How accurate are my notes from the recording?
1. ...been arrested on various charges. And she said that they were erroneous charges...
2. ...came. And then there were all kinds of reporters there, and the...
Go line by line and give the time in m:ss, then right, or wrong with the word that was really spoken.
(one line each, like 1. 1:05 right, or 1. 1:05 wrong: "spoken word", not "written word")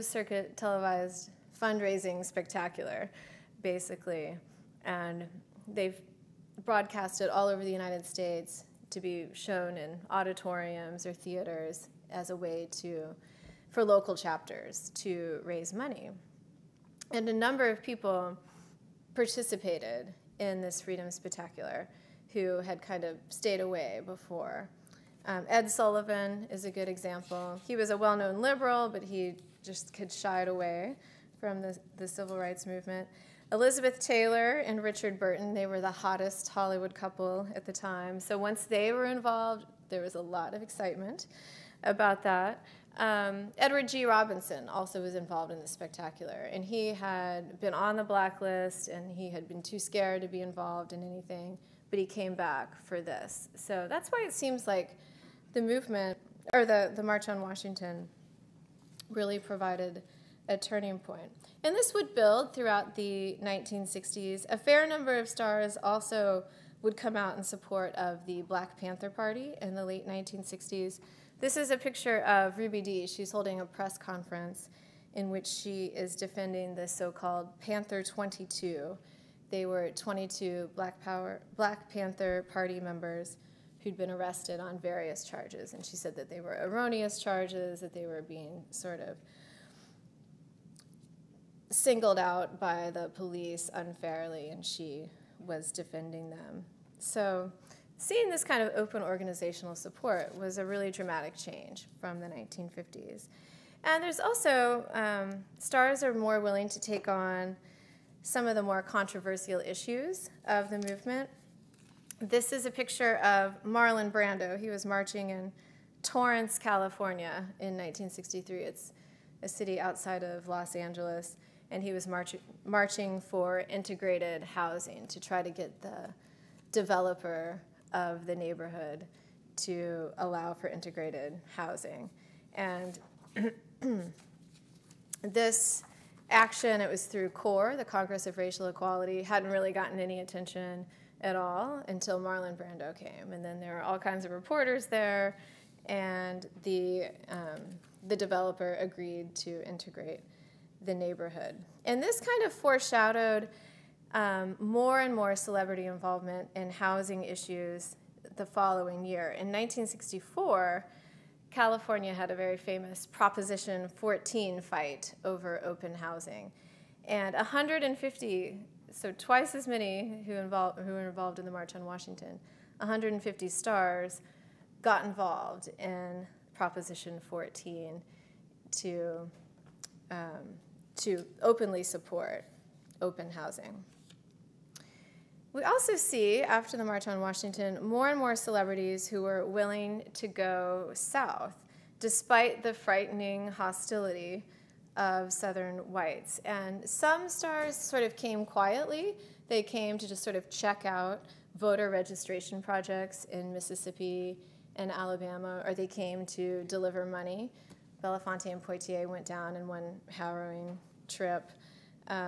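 1. 1:23 right
2. 2:22 right.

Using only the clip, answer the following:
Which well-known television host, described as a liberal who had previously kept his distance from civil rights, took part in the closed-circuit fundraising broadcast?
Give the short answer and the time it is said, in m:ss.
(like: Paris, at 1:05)
Ed Sullivan, at 0:25.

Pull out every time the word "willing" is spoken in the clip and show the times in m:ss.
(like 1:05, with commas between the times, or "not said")
1:46, 3:09.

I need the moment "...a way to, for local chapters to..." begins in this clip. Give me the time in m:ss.
0:12.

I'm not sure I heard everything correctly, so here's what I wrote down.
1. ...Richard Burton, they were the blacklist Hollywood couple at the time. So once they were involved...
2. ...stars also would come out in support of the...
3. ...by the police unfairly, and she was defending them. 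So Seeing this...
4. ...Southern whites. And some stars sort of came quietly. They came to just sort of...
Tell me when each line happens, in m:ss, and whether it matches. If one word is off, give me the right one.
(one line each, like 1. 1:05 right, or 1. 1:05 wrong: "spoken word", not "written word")
1. 0:34 wrong: "hottest", not "blacklist"
2. 1:05 right
3. 1:32 right
4. 3:15 right.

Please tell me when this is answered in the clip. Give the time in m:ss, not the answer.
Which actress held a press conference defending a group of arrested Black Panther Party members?
1:12.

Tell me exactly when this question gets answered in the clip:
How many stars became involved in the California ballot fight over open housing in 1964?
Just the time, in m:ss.
2:52.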